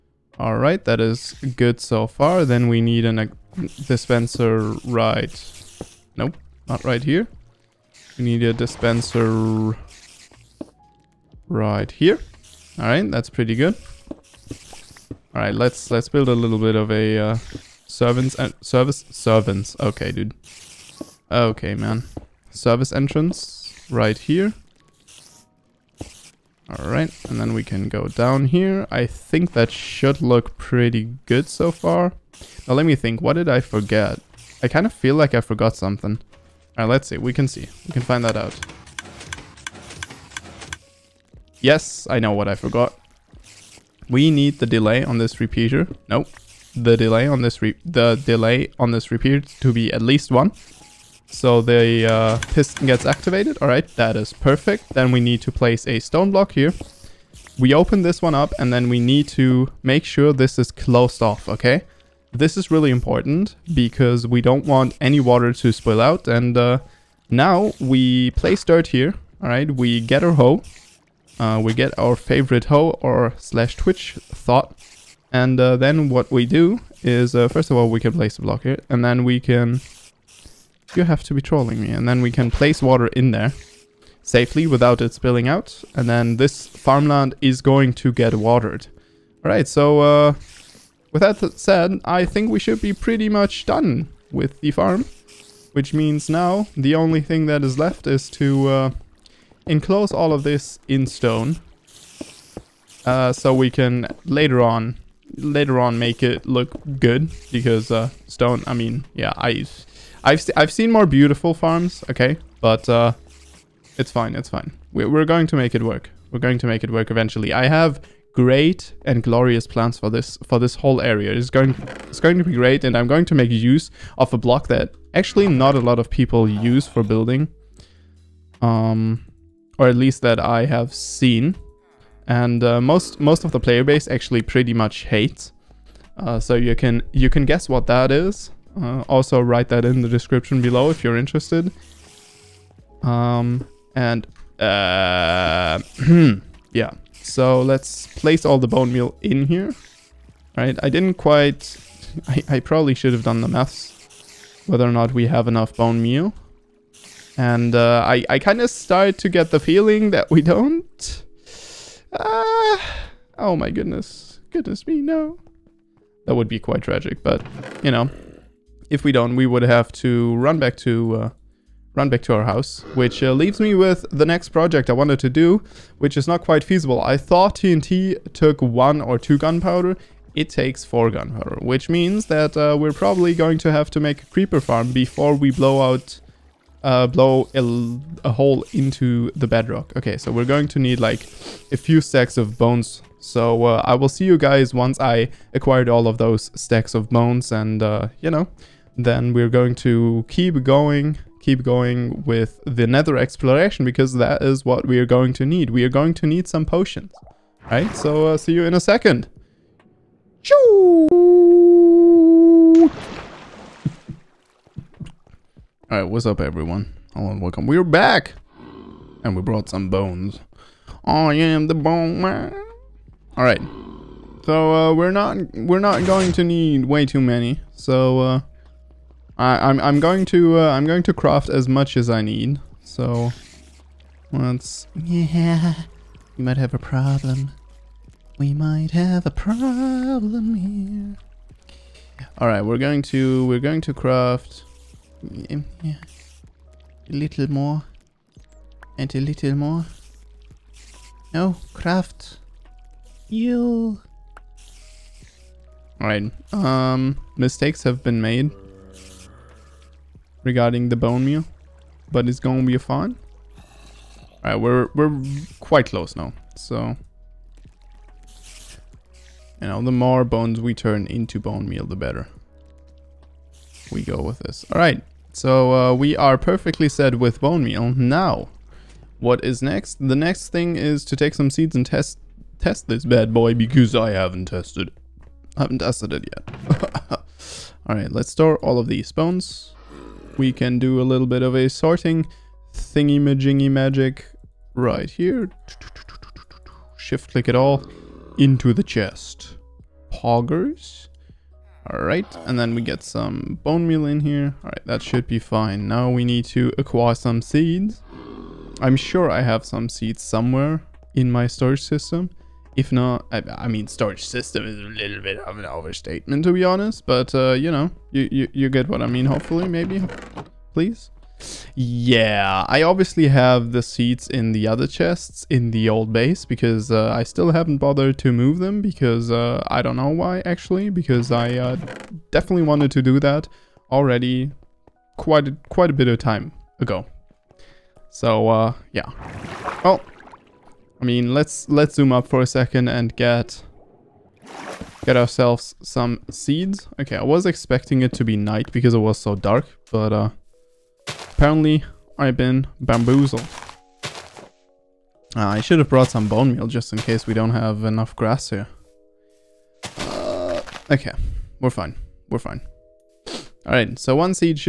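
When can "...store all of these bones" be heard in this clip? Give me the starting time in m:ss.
4:48.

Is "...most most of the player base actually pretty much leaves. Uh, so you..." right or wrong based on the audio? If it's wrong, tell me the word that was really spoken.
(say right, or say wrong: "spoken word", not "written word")
wrong: "hates", not "leaves".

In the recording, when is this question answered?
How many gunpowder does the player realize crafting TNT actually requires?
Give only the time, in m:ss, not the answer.
3:00.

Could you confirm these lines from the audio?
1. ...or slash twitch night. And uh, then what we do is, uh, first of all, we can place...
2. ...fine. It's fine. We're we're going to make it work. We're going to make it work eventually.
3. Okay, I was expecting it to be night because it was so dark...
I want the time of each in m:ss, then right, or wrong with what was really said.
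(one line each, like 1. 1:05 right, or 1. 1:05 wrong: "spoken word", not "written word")
1. 1:13 wrong: "thought", not "night"
2. 1:54 right
3. 5:47 right.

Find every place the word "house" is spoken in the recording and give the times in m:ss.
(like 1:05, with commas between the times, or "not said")
2:52.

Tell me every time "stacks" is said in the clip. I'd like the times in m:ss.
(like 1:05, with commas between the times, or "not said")
3:12, 3:16.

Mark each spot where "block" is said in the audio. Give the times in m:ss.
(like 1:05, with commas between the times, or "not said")
0:56, 1:18, 2:04.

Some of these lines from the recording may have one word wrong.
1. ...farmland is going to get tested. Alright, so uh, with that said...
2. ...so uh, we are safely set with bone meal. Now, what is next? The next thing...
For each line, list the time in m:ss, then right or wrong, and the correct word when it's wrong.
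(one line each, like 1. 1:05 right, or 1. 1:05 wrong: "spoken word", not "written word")
1. 1:26 wrong: "watered", not "tested"
2. 4:35 wrong: "perfectly", not "safely".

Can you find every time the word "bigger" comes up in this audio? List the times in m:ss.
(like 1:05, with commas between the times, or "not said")
not said.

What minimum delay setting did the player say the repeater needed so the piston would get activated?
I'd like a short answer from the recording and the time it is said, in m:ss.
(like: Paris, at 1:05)
1, at 0:49.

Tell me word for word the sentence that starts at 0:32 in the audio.
Now let me think, what did I forget?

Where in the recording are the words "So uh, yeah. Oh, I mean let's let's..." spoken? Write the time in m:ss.
5:38.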